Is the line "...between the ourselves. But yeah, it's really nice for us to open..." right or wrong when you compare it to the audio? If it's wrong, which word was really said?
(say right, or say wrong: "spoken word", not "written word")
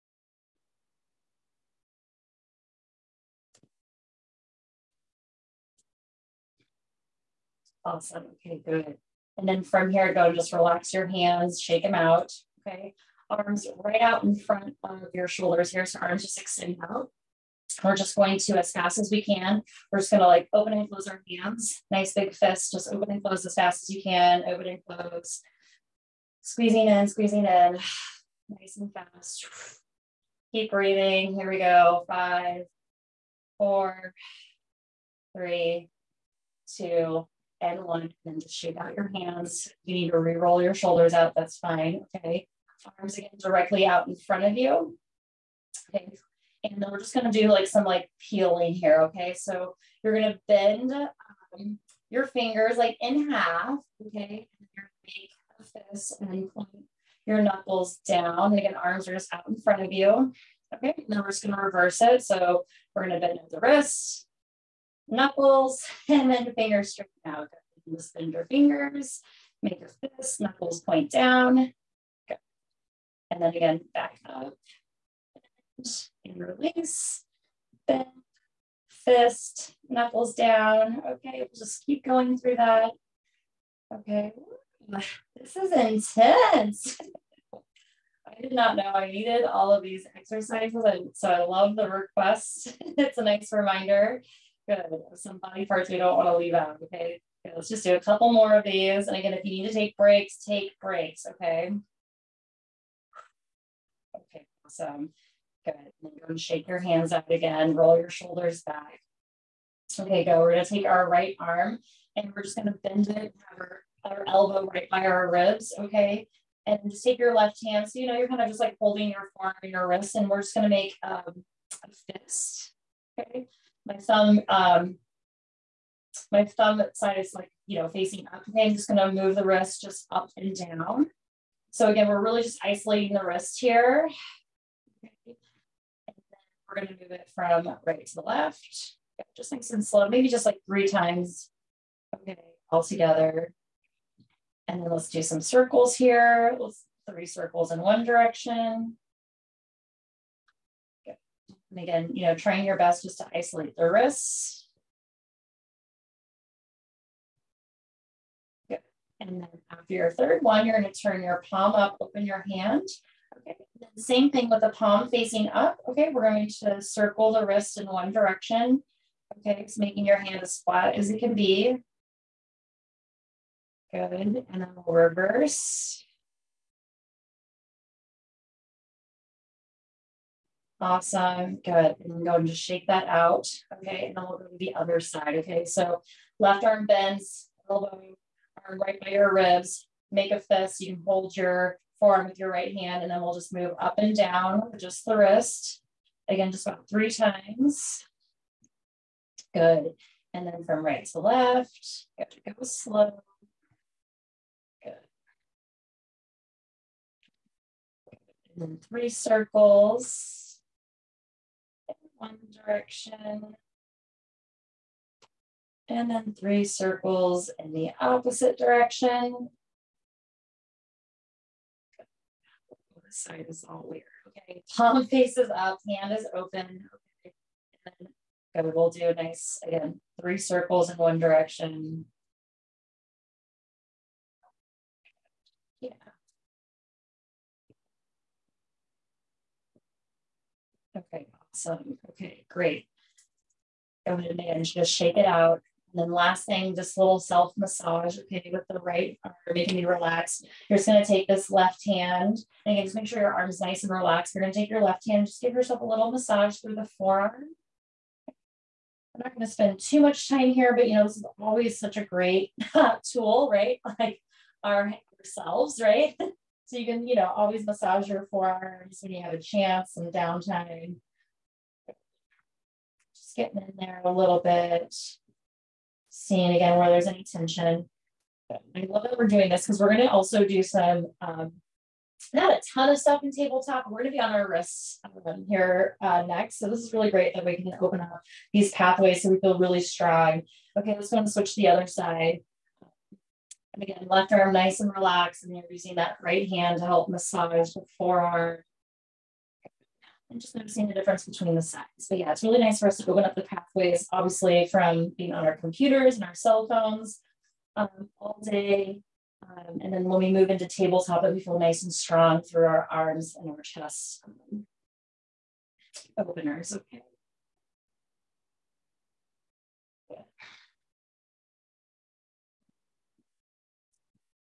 wrong: "sides", not "ourselves".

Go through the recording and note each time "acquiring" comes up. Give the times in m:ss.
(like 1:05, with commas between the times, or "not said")
not said.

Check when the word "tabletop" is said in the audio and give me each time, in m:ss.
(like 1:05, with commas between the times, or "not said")
4:43, 5:10.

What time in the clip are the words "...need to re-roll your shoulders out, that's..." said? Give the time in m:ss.
0:39.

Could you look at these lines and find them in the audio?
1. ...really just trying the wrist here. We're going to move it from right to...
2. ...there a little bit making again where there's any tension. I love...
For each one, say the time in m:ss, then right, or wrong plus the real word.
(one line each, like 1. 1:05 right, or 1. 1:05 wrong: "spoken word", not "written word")
1. 2:12 wrong: "isolating", not "trying"
2. 4:33 wrong: "seeing", not "making".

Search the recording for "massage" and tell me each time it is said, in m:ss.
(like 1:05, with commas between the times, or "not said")
4:07, 4:16, 4:27, 4:57.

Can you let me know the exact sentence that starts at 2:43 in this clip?
Same thing with the palm facing up.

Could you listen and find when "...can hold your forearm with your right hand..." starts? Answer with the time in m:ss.
3:10.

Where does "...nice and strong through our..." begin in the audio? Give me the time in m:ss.
5:11.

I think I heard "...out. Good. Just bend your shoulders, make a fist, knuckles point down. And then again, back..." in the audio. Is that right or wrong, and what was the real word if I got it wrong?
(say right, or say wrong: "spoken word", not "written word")
wrong: "fingers", not "shoulders".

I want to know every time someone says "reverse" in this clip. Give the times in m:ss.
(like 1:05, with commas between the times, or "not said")
1:01, 2:54.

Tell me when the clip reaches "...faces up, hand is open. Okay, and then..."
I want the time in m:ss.
3:45.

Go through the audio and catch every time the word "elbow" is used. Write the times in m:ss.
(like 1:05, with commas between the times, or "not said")
1:54, 3:07.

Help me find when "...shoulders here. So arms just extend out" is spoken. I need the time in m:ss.
0:15.